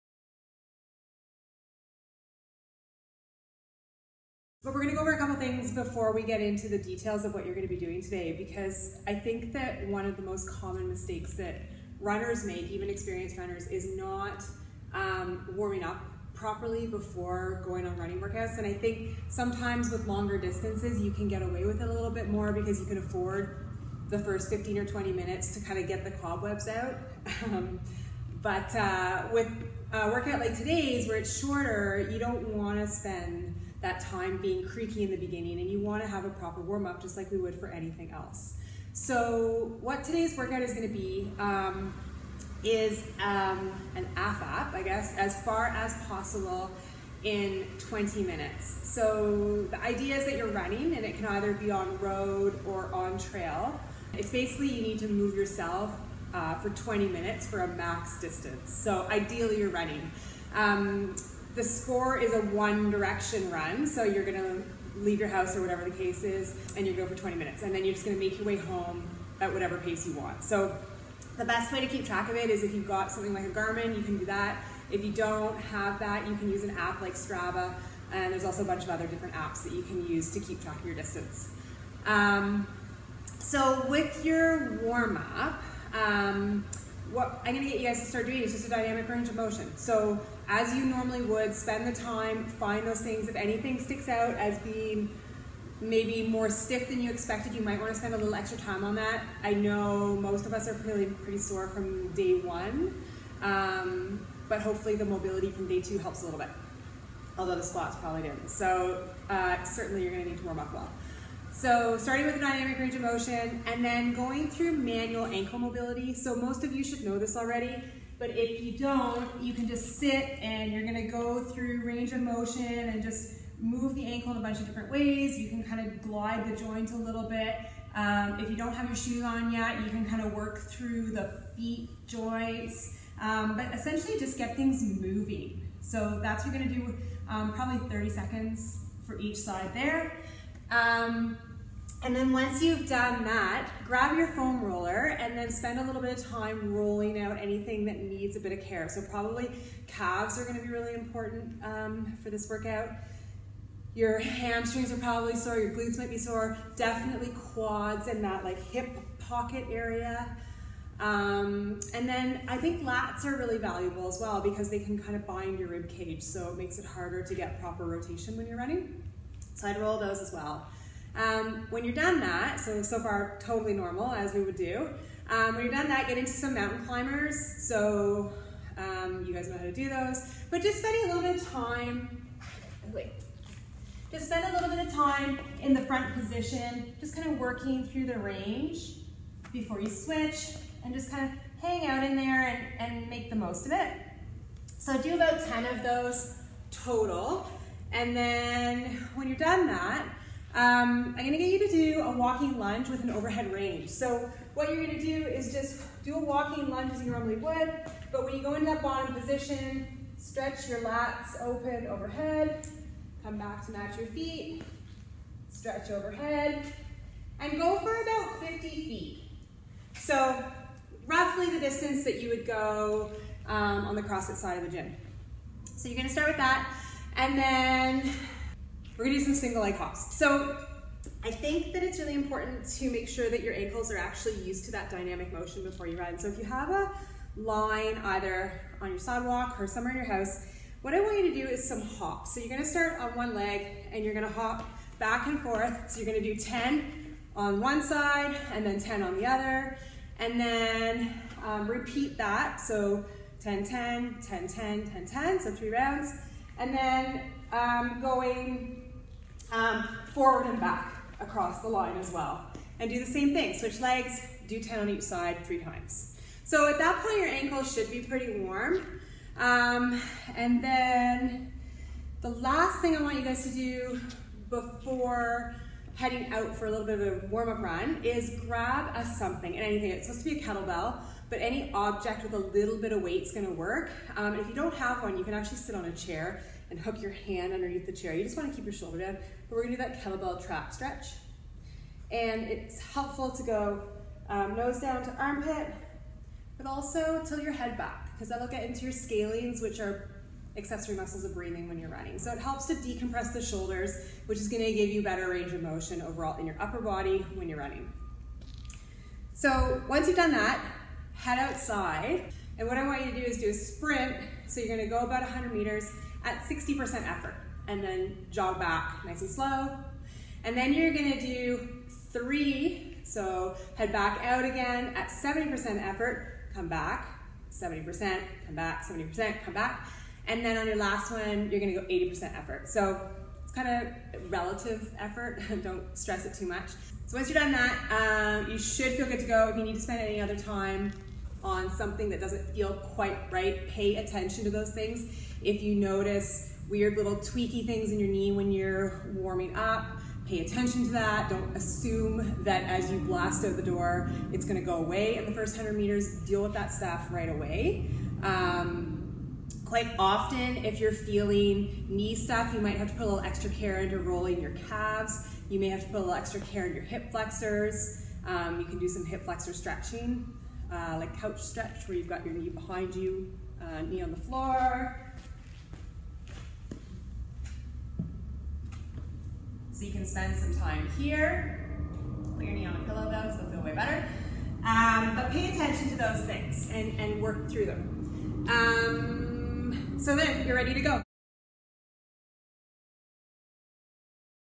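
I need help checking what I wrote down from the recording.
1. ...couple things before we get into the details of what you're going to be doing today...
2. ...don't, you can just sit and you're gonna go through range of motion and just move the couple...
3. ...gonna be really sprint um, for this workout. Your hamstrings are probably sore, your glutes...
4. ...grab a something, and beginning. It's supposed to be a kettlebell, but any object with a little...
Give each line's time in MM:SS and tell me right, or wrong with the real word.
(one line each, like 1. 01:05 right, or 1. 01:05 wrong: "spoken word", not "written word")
1. 00:05 right
2. 01:58 wrong: "ankle", not "couple"
3. 02:30 wrong: "important", not "sprint"
4. 04:38 wrong: "anything", not "beginning".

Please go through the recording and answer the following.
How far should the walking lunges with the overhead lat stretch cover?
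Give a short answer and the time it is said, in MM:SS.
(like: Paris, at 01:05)
50 feet, at 03:38.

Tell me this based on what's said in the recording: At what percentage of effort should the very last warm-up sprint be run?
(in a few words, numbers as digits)
80%.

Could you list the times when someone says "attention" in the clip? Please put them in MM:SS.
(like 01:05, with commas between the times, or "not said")
05:43, 05:50, 06:25.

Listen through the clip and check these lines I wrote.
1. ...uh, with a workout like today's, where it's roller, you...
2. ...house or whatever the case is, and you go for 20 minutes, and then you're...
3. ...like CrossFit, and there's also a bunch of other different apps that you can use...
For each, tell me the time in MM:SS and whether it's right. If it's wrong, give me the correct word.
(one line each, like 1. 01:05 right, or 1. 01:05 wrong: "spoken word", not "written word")
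1. 00:28 wrong: "shorter", not "roller"
2. 01:05 right
3. 01:17 wrong: "Strava", not "CrossFit".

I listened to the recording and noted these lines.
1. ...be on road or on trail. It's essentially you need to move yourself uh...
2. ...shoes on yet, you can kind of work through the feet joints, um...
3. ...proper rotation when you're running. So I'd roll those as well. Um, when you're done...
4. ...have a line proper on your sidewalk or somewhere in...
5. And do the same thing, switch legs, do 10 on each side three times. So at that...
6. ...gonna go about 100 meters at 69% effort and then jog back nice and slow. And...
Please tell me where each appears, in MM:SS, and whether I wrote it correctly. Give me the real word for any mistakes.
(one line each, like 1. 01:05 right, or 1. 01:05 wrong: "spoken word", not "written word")
1. 00:51 wrong: "basically", not "essentially"
2. 02:08 right
3. 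02:47 right
4. 03:56 wrong: "either", not "proper"
5. 04:22 right
6. 05:14 wrong: "60", not "69".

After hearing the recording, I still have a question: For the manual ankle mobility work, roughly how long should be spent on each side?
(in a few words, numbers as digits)
30 seconds.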